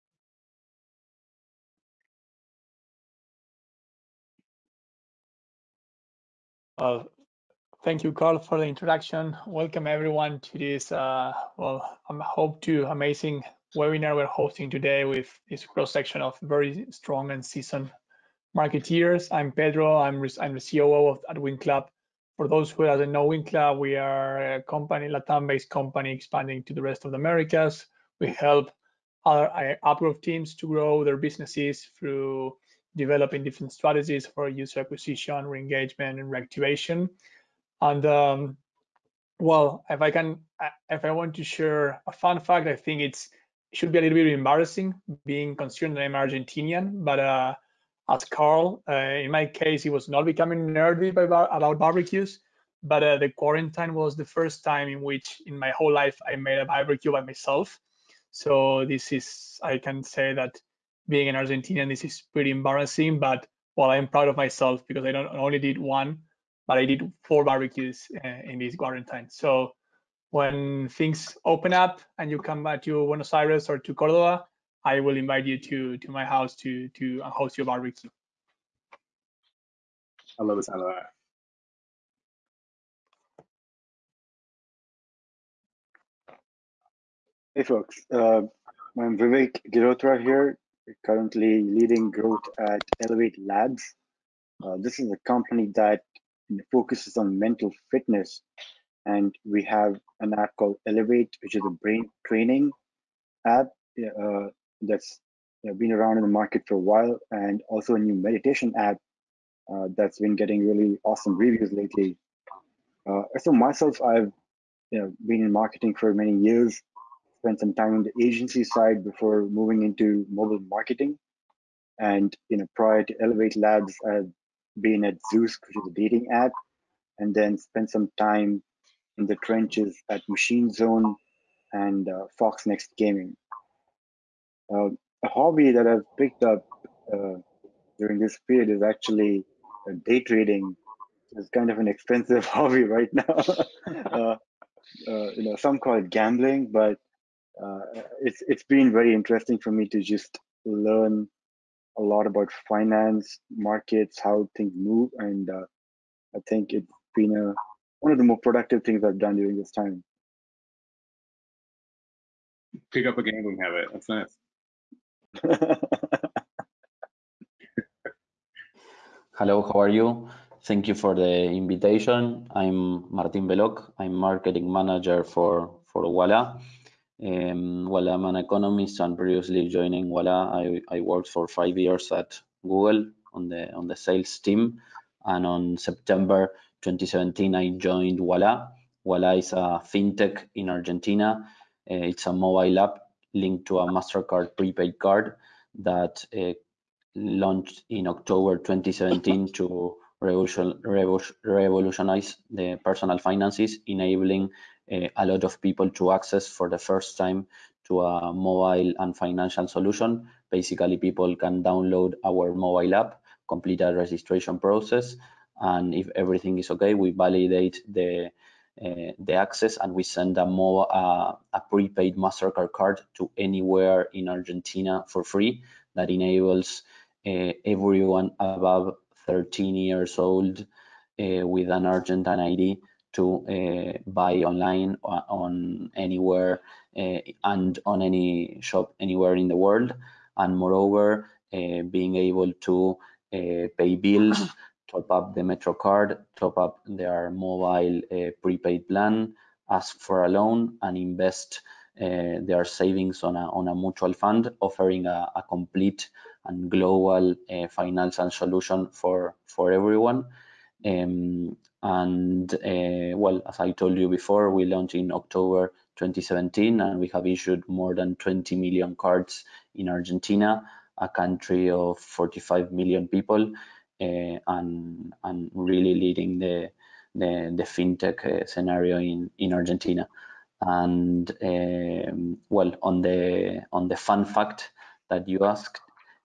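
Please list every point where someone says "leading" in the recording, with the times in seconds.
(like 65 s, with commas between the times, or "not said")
91 s, 275 s.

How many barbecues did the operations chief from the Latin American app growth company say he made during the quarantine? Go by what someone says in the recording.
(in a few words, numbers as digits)
4.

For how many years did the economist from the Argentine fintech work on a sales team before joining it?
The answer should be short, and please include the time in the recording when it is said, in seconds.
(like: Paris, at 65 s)
5, at 181 s.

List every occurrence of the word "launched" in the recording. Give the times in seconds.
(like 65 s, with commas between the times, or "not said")
197 s, 264 s.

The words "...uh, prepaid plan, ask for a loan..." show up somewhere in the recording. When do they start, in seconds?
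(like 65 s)
248 s.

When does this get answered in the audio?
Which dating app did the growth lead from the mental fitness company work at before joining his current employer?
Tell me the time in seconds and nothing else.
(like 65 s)
125 s.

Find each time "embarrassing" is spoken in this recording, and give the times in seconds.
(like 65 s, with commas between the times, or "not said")
44 s, 62 s.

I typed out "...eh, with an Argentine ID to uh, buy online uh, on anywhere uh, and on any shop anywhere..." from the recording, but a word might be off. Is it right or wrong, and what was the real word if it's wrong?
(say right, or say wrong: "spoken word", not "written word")
right.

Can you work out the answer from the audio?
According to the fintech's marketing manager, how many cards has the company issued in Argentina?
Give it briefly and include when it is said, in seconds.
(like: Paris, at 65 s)
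More than 20 million, at 267 s.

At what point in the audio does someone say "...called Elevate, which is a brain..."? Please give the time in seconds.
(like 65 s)
100 s.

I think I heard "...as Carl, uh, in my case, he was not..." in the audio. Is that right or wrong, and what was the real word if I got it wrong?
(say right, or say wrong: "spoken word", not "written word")
right.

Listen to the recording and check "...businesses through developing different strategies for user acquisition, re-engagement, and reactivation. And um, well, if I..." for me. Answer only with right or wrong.
right.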